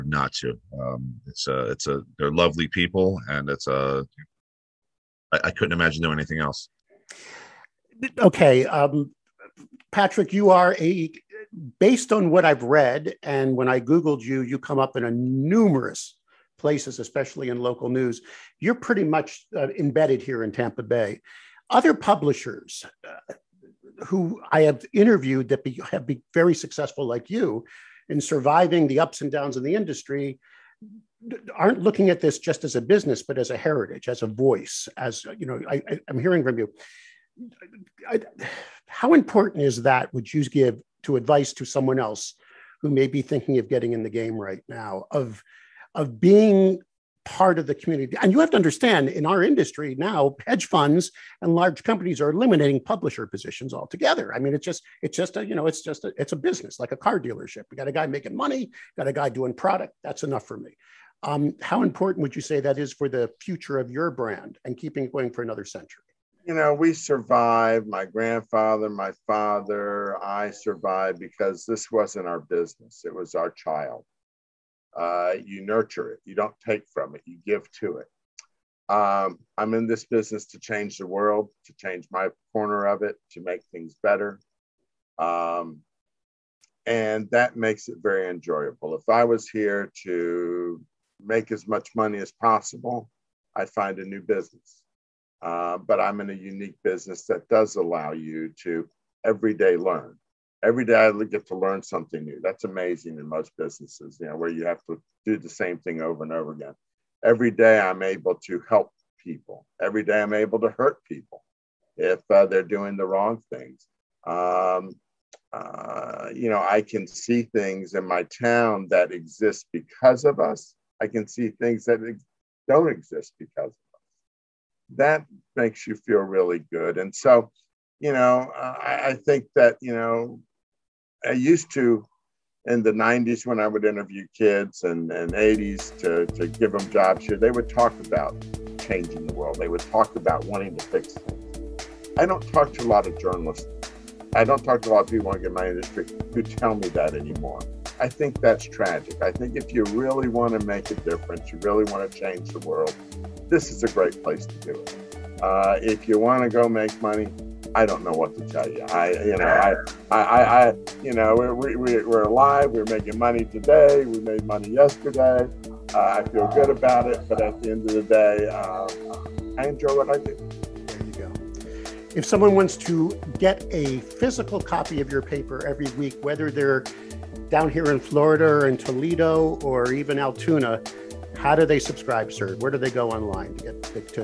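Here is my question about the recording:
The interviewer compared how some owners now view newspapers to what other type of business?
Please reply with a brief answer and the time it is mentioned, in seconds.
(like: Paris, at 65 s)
A car dealership, at 56 s.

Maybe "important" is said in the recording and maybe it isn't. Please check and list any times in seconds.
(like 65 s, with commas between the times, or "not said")
39 s, 61 s.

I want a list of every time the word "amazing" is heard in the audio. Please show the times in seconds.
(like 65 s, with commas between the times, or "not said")
102 s.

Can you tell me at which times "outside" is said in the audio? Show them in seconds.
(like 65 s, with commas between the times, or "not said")
not said.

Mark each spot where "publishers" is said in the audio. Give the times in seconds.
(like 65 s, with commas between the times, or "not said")
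21 s, 52 s.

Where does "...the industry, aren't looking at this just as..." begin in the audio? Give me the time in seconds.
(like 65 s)
29 s.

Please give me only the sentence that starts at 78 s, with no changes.
Um, I'm in this business to change the world, to change my corner of it, to make things better.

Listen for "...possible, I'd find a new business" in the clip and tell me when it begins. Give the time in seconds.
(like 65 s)
92 s.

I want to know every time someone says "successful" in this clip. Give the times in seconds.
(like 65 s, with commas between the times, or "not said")
26 s.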